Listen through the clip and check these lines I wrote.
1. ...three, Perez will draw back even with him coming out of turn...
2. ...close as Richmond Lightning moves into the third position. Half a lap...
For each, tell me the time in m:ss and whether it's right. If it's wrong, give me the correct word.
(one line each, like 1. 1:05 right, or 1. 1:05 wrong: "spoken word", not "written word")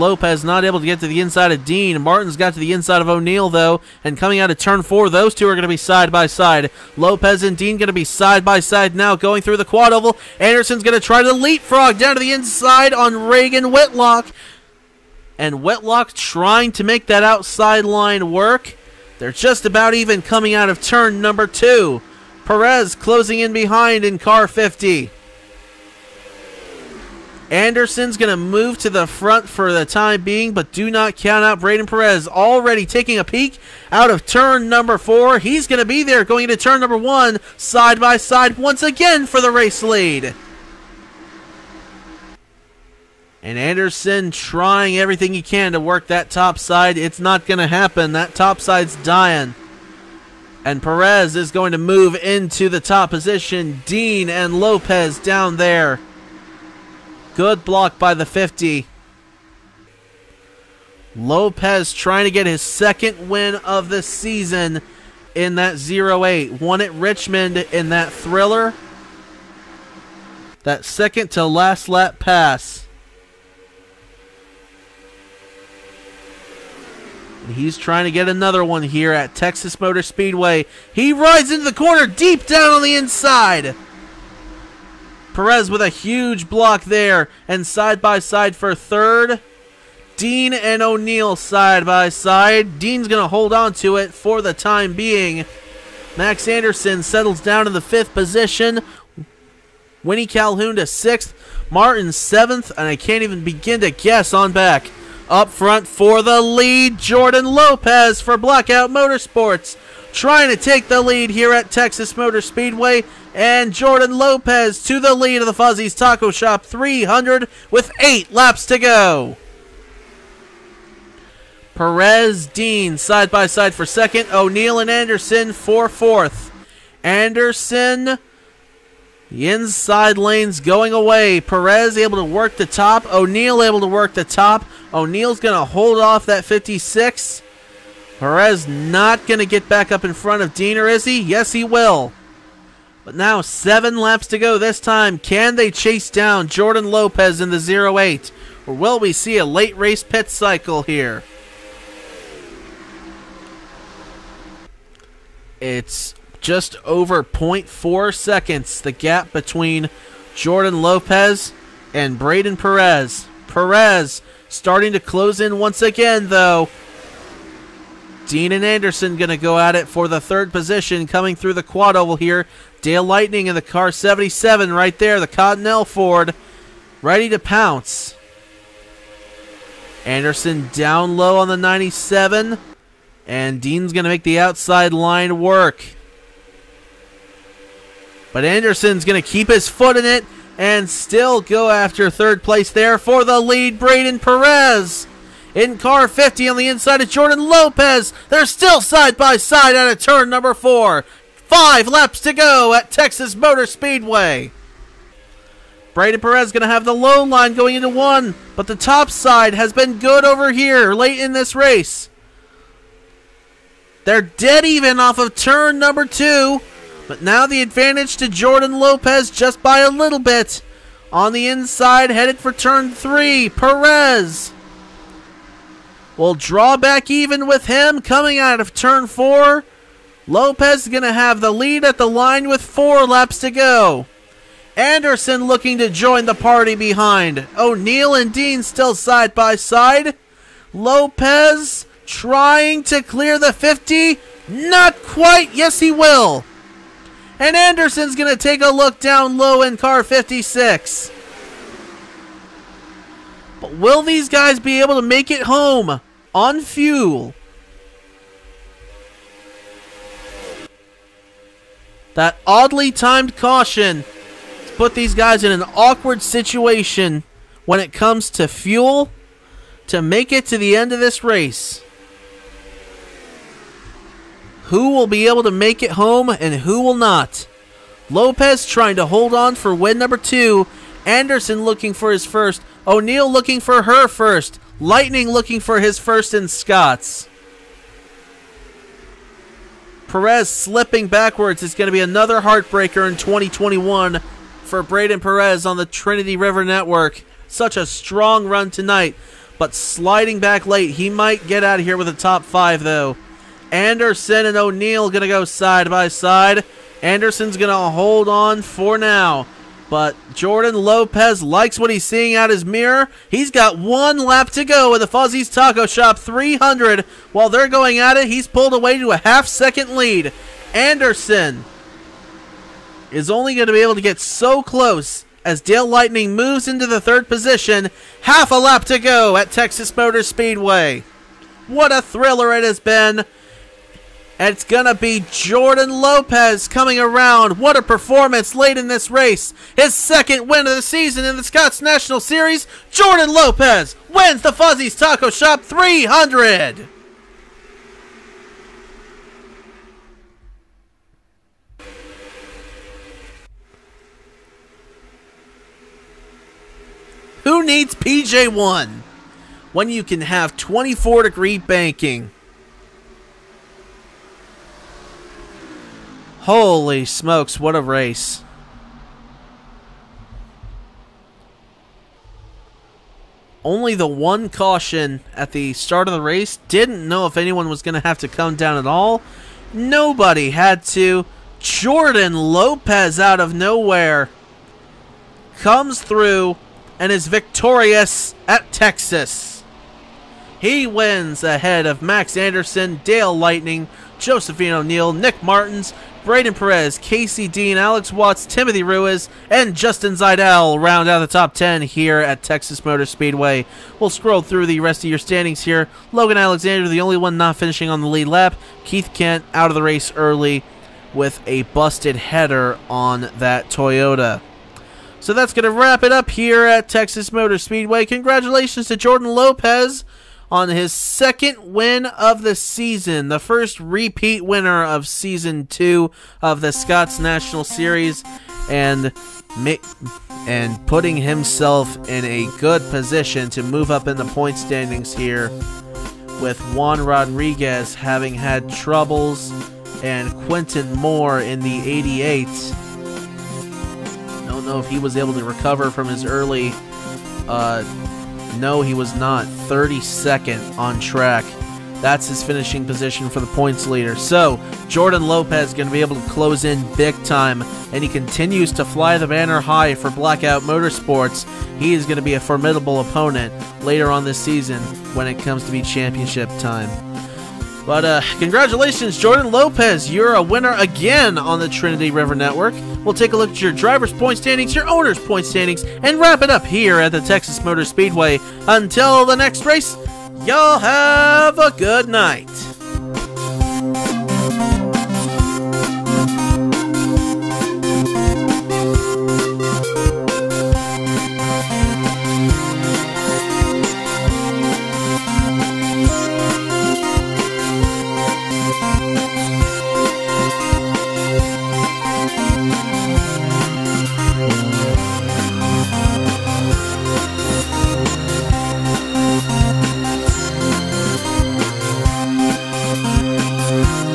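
1. 3:42 right
2. 5:24 wrong: "Dale", not "Richmond".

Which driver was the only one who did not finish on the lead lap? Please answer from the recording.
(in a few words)
Logan Alexander.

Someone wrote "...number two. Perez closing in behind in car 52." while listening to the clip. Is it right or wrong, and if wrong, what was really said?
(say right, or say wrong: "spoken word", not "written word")
wrong: "50", not "52".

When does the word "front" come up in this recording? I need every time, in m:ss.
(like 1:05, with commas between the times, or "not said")
0:29, 1:45, 2:20.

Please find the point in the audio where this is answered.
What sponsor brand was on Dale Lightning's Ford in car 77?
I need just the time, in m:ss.
2:55.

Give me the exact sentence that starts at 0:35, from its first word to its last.
He's going to be there going into turn number one, side by side once again for the race lead.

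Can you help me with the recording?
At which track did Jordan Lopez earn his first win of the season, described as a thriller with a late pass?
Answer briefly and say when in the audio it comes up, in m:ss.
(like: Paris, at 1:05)
Richmond, at 1:06.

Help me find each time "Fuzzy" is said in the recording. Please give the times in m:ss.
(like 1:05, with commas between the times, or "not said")
1:55, 5:15, 5:44.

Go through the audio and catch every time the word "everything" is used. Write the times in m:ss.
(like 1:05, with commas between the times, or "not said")
0:44.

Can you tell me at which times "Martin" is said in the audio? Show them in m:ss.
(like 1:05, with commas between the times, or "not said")
0:02, 1:41, 6:35.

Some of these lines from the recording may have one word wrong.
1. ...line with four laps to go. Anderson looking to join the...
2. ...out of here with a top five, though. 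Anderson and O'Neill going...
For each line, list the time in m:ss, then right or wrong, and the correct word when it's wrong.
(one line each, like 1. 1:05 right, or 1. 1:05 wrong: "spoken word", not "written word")
1. 3:52 right
2. 5:01 right.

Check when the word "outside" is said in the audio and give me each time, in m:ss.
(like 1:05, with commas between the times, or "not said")
0:17, 3:04.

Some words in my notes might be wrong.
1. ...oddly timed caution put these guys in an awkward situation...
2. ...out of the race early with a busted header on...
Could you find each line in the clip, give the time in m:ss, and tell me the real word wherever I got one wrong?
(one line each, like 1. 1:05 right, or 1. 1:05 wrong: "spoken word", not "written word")
1. 4:22 right
2. 6:49 right.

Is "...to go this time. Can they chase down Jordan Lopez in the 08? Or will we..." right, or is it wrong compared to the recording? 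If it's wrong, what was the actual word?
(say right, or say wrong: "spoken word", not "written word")
right.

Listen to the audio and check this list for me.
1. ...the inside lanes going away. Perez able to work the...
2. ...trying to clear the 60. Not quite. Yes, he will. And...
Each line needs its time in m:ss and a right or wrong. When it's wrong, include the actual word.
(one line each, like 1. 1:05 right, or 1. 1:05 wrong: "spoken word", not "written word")
1. 2:09 right
2. 4:02 wrong: "50", not "60".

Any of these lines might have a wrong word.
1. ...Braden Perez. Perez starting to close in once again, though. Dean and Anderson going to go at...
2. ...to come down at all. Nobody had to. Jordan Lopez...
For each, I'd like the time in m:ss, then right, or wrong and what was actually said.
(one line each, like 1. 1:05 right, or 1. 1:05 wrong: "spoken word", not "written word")
1. 2:42 right
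2. 6:18 right.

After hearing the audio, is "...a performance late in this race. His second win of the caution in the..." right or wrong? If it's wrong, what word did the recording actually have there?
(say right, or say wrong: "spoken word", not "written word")
wrong: "season", not "caution".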